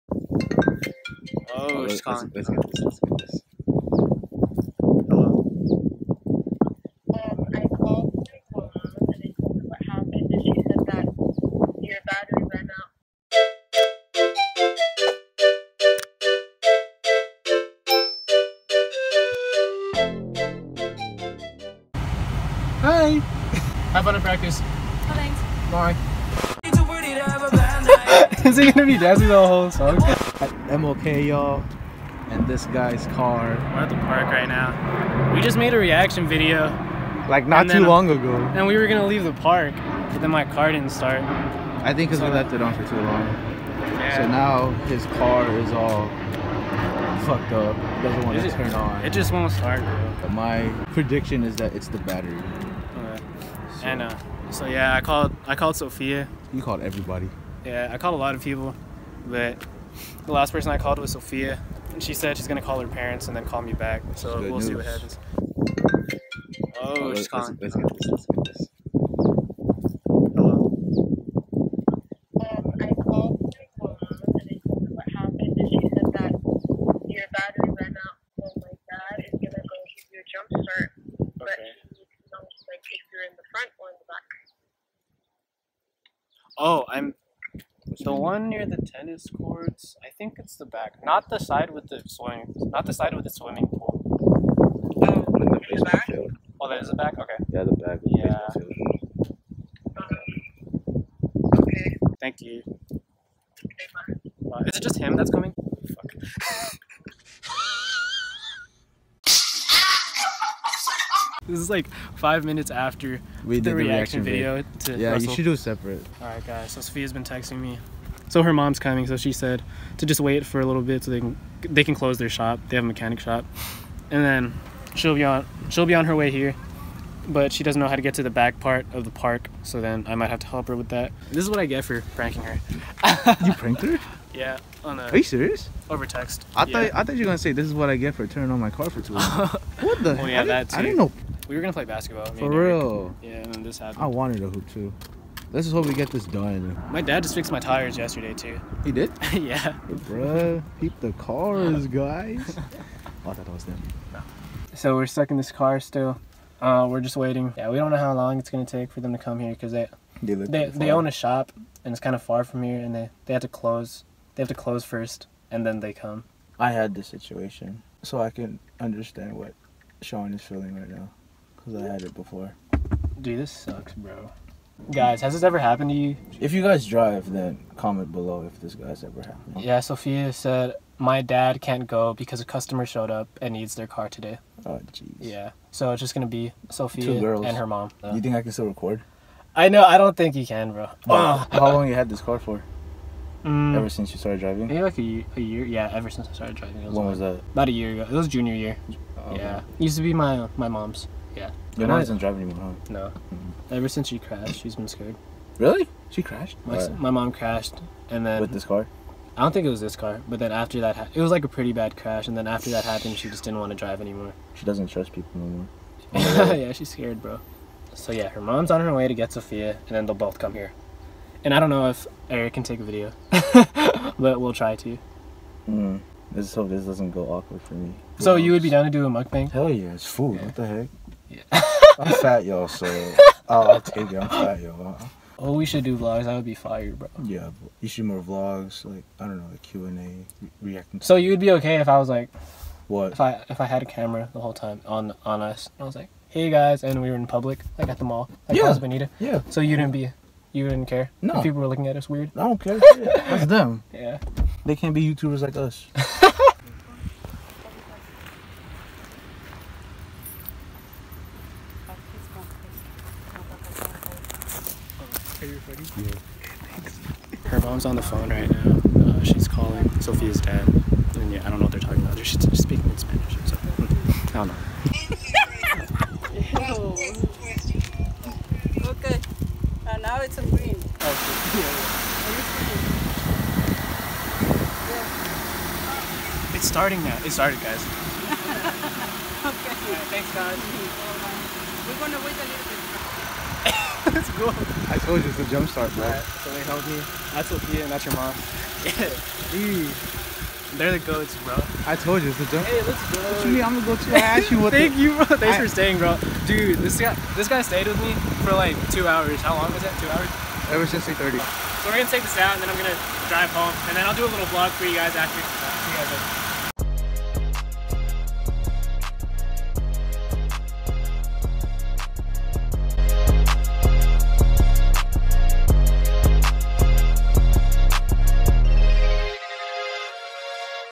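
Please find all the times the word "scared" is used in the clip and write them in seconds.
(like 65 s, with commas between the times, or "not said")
204 s, 216 s.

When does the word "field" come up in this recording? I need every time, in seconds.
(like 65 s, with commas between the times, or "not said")
96 s, 100 s.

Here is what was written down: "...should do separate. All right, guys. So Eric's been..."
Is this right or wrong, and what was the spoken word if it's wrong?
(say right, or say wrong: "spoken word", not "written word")
wrong: "Sophia", not "Eric".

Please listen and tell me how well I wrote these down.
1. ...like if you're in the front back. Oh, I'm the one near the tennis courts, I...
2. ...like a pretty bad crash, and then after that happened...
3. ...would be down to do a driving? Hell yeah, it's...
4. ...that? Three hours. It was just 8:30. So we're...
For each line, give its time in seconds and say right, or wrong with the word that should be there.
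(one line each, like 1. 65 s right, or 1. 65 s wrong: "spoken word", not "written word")
1. 81 s right
2. 211 s right
3. 228 s wrong: "mukbang", not "driving"
4. 309 s wrong: "Two", not "Three".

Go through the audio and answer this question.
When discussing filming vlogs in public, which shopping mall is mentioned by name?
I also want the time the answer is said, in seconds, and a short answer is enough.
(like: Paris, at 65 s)
Plaza Bonita, at 248 s.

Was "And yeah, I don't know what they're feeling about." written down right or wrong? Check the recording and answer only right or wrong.
wrong.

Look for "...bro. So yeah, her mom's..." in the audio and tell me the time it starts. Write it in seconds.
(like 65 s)
217 s.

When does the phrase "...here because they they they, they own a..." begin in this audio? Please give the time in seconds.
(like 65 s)
159 s.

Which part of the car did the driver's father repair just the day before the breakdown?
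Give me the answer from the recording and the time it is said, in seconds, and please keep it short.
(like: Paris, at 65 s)
tires, at 147 s.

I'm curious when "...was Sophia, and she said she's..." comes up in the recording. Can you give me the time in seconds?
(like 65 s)
60 s.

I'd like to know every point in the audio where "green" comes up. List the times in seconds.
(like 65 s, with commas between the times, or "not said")
280 s.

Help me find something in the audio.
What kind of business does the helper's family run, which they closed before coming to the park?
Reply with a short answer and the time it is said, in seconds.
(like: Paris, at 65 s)
mechanic shop, at 122 s.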